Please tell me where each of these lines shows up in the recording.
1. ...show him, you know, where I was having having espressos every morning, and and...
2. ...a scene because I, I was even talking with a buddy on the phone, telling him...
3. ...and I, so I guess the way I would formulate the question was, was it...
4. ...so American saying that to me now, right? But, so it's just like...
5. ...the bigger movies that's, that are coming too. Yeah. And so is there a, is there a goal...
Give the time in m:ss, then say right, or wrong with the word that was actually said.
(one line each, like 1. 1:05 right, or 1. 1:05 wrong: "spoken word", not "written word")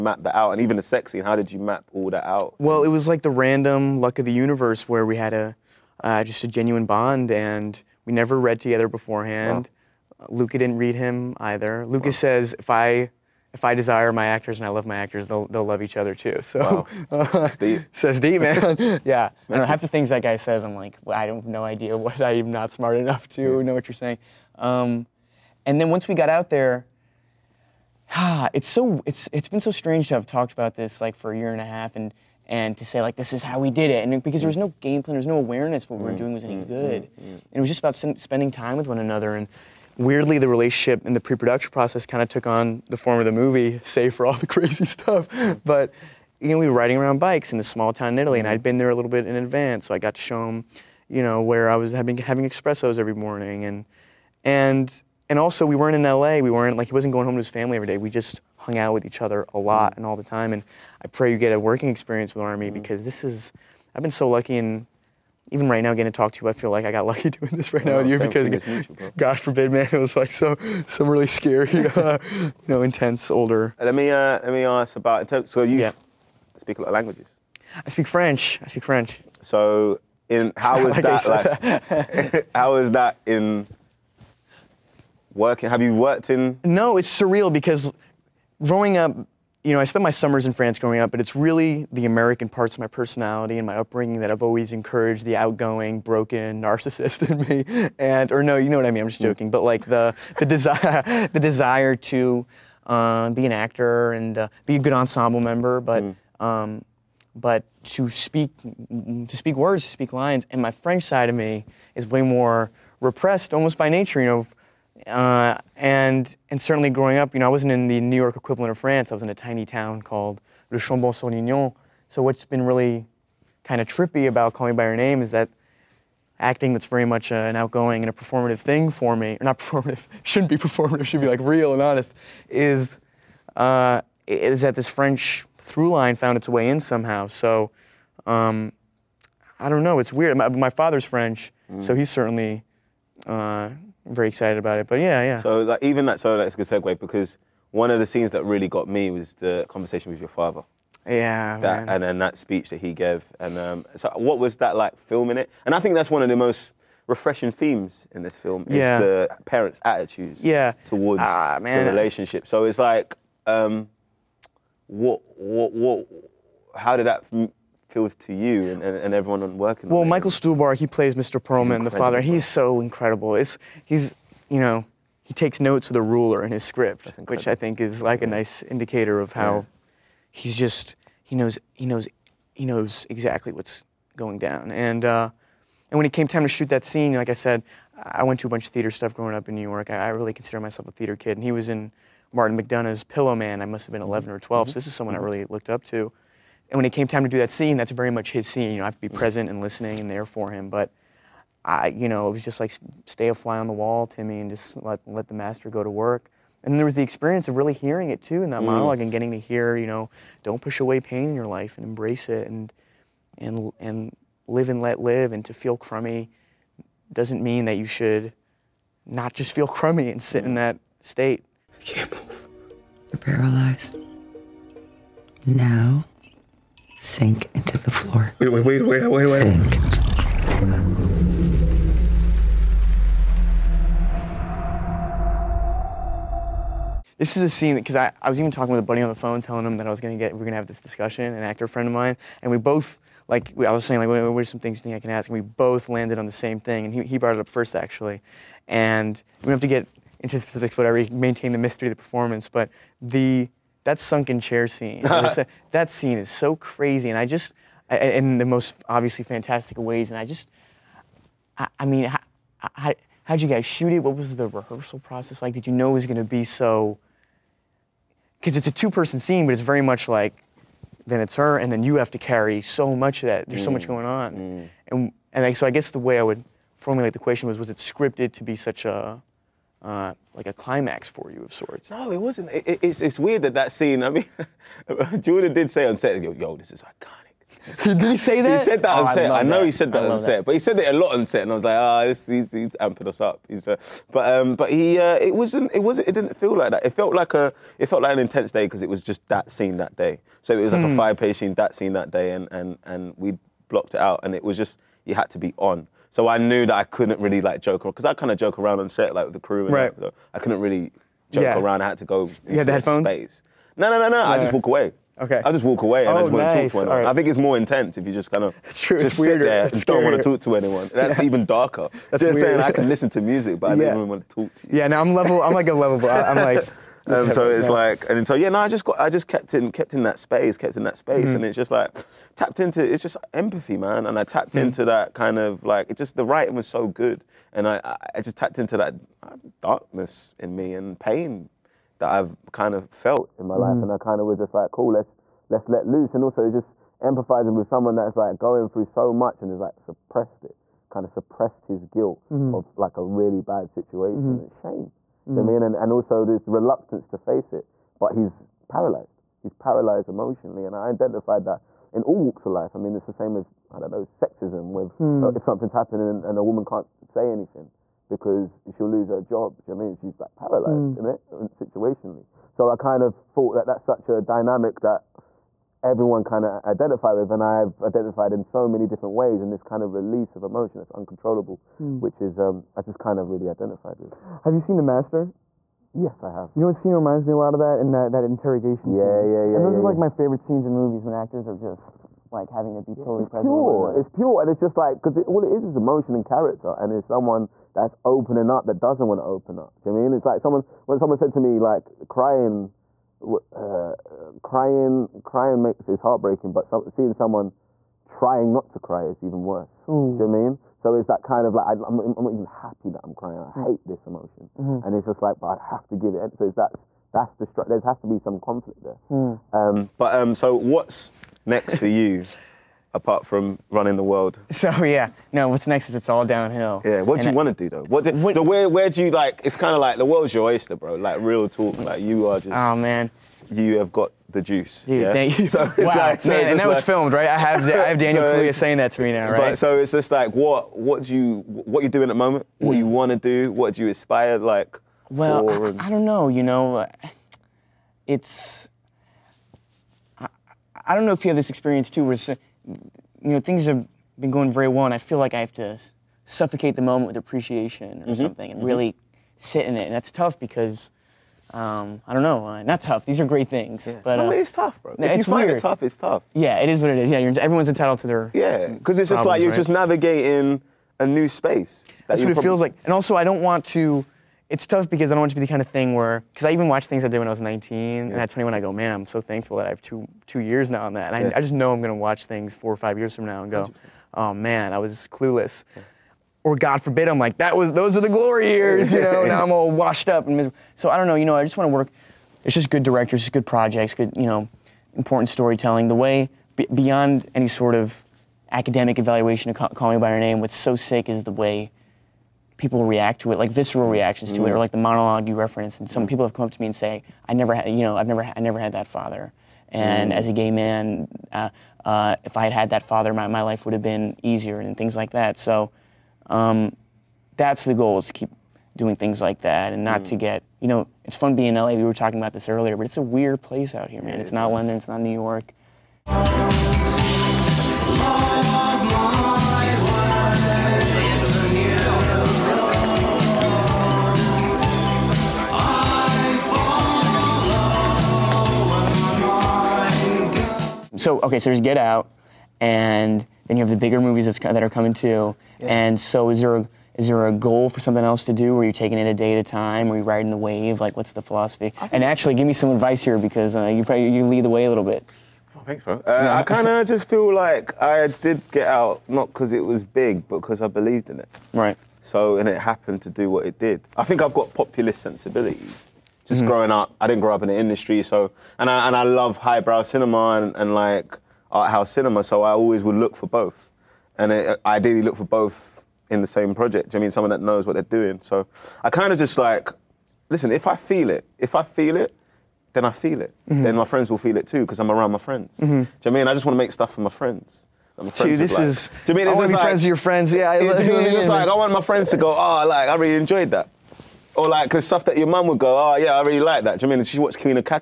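1. 0:50 right
2. 3:57 right
3. 4:35 right
4. 7:18 wrong: "Kaluuya", not "American"
5. 9:03 right.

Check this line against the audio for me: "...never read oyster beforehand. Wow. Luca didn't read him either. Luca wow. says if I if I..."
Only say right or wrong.
wrong.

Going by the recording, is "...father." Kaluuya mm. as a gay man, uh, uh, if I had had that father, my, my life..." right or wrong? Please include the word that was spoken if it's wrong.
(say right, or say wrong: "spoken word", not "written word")
wrong: "And", not "Kaluuya".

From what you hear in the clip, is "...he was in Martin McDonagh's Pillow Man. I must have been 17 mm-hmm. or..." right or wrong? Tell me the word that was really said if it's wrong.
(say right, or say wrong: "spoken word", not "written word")
wrong: "11", not "17".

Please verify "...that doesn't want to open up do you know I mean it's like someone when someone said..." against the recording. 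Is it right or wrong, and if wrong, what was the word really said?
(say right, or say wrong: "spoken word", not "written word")
right.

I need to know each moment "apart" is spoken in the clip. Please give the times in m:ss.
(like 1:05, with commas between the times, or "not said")
7:02.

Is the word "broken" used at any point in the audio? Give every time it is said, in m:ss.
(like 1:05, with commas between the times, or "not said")
1:36.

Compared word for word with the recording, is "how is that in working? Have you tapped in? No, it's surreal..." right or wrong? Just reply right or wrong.
wrong.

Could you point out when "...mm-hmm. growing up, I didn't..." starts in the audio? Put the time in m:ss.
9:26.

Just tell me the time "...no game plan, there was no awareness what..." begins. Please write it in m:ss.
0:34.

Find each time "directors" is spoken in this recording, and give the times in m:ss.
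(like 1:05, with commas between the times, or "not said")
8:12.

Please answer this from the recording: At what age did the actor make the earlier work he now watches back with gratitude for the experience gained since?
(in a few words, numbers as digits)
19.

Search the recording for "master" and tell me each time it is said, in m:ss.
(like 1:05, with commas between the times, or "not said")
3:25, 6:24.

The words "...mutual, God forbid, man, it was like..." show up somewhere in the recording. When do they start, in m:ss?
1:08.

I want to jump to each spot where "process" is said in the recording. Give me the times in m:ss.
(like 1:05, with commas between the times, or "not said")
0:41, 4:25.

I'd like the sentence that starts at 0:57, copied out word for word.
We just hung out with each other a lot and all the time.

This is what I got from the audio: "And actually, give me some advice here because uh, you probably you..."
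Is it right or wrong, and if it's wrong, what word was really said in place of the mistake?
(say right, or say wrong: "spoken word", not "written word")
right.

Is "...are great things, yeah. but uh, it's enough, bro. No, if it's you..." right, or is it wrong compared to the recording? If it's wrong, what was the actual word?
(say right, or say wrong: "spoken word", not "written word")
wrong: "tough", not "enough".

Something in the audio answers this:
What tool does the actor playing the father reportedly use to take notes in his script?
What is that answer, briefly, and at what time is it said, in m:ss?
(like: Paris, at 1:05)
A ruler, at 2:56.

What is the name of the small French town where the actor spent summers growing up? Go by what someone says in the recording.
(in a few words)
Le Chambon-sur-Lignon.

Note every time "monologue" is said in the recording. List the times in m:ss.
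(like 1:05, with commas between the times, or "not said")
3:28, 8:24.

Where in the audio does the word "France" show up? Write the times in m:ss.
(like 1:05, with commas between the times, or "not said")
1:30, 1:58.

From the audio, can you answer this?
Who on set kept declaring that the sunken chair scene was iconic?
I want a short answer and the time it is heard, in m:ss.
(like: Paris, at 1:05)
Jordan, at 4:45.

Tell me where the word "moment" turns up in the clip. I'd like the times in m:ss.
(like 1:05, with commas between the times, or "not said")
7:22, 7:36.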